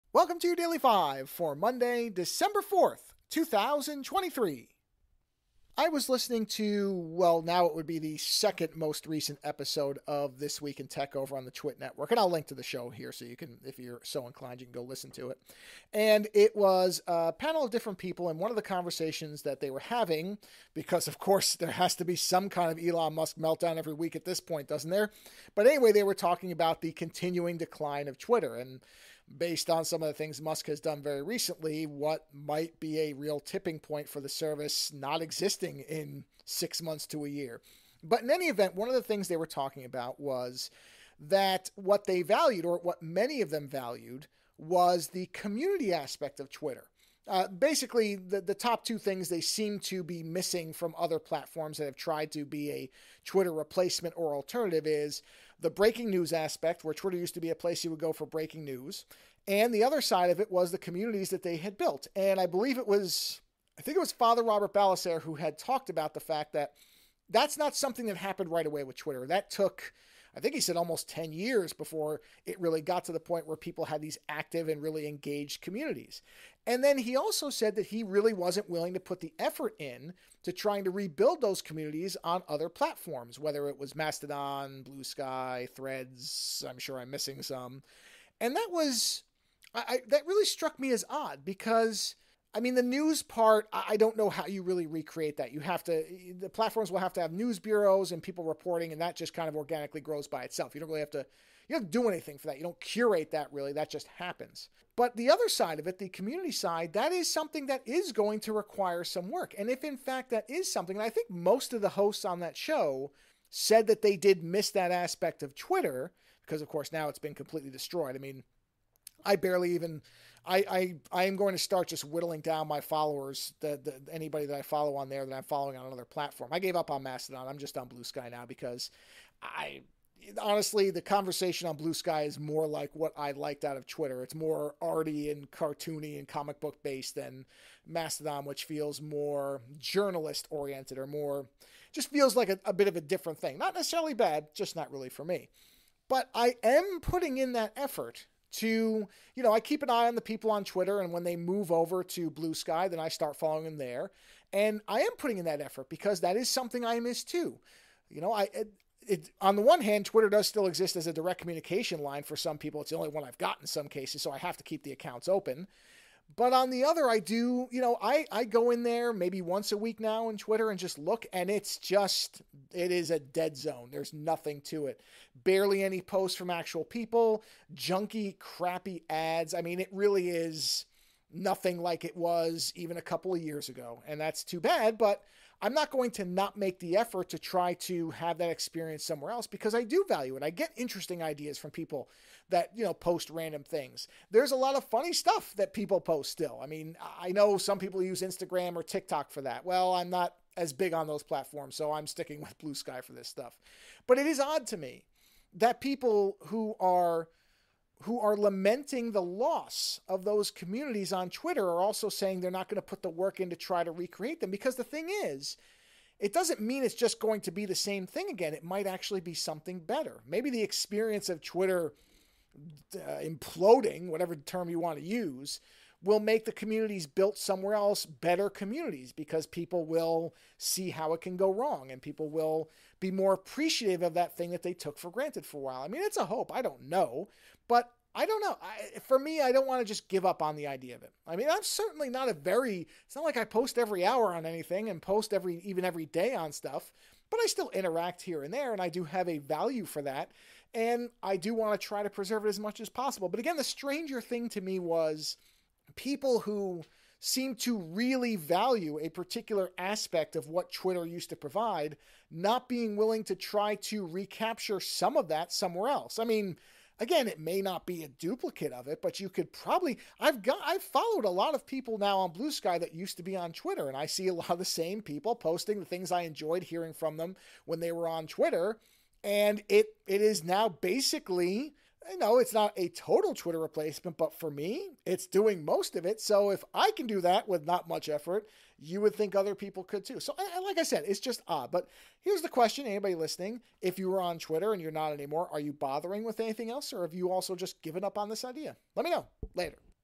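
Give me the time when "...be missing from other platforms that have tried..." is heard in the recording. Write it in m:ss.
0:50.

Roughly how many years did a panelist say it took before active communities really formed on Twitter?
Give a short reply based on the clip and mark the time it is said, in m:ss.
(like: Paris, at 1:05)
10, at 1:11.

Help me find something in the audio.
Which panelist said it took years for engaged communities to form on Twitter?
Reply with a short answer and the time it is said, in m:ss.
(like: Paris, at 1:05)
Father Robert Ballecer, at 1:04.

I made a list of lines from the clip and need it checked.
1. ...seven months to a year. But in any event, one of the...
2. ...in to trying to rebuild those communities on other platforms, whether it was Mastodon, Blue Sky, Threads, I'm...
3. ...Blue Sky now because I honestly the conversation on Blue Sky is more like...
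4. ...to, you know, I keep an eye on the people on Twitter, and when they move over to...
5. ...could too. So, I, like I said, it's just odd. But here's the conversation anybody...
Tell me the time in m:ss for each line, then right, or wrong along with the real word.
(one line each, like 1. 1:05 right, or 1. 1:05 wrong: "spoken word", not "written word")
1. 0:36 wrong: "six", not "seven"
2. 1:19 right
3. 2:07 right
4. 2:28 right
5. 4:49 wrong: "question", not "conversation".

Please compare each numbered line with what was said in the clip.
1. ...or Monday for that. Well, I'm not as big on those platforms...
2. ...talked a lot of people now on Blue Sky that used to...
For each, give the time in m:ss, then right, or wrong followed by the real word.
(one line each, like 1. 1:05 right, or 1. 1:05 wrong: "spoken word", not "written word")
1. 3:18 wrong: "TikTok", not "Monday"
2. 4:30 wrong: "followed", not "talked".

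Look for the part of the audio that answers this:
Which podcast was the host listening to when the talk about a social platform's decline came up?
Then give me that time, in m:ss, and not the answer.
0:10.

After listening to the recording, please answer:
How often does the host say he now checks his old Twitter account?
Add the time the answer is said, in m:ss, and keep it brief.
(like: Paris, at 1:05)
Once a week, at 2:49.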